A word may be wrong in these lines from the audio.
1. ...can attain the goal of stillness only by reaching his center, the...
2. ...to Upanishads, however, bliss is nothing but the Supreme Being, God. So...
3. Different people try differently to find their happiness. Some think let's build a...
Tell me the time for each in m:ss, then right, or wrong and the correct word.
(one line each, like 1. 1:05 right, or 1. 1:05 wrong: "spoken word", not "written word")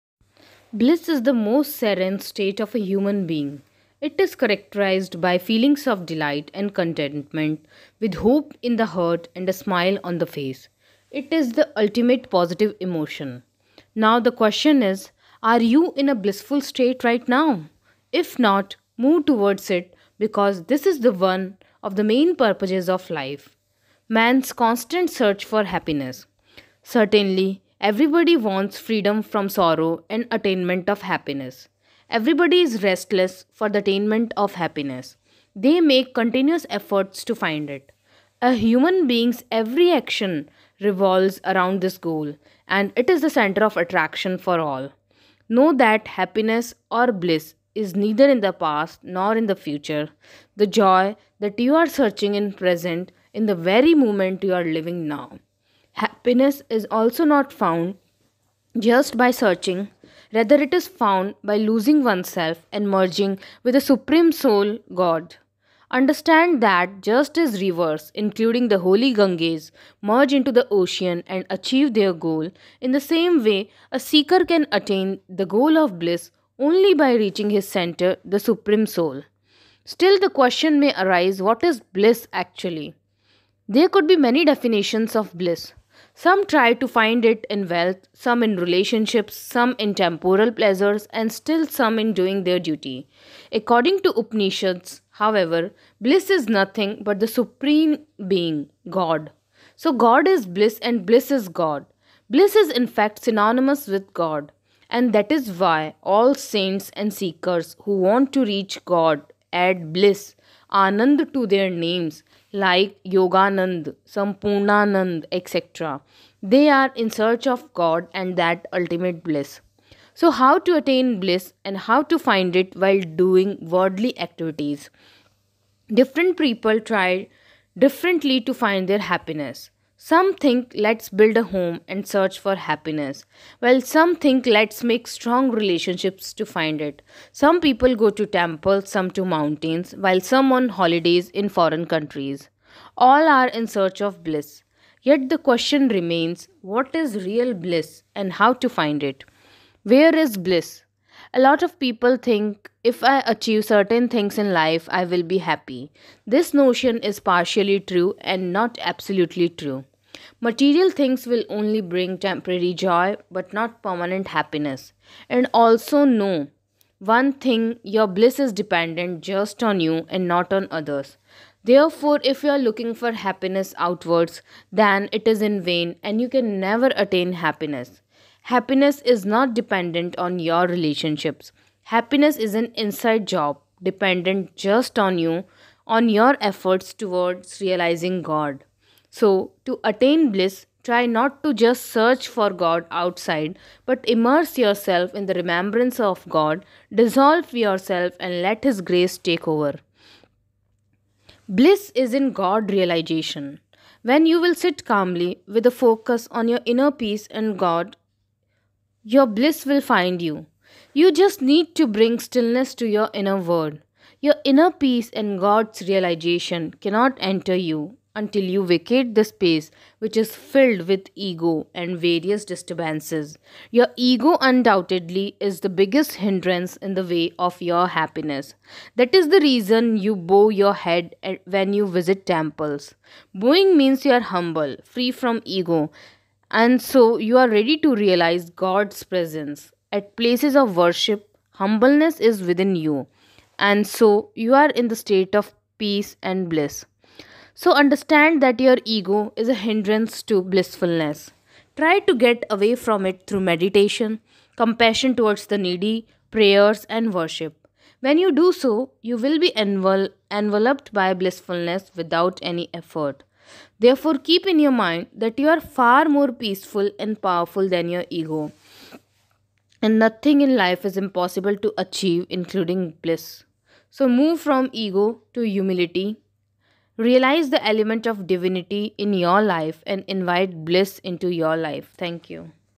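1. 1:14 wrong: "bliss", not "stillness"
2. 1:34 right
3. 2:05 right.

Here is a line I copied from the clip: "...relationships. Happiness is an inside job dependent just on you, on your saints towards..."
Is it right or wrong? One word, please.
wrong.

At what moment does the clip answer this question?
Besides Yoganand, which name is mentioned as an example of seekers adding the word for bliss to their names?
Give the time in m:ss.
1:54.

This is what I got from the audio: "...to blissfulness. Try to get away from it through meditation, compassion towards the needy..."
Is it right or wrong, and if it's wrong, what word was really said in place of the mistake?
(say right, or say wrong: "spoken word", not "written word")
right.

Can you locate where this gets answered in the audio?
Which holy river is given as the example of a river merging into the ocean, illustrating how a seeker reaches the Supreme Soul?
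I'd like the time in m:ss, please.
1:09.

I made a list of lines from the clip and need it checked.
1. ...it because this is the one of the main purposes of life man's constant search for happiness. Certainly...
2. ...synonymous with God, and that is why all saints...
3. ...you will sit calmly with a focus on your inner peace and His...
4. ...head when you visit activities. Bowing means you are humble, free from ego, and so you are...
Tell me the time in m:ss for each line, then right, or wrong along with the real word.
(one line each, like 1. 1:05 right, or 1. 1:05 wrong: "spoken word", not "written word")
1. 0:19 right
2. 1:43 right
3. 3:24 wrong: "God", not "His"
4. 3:50 wrong: "temples", not "activities".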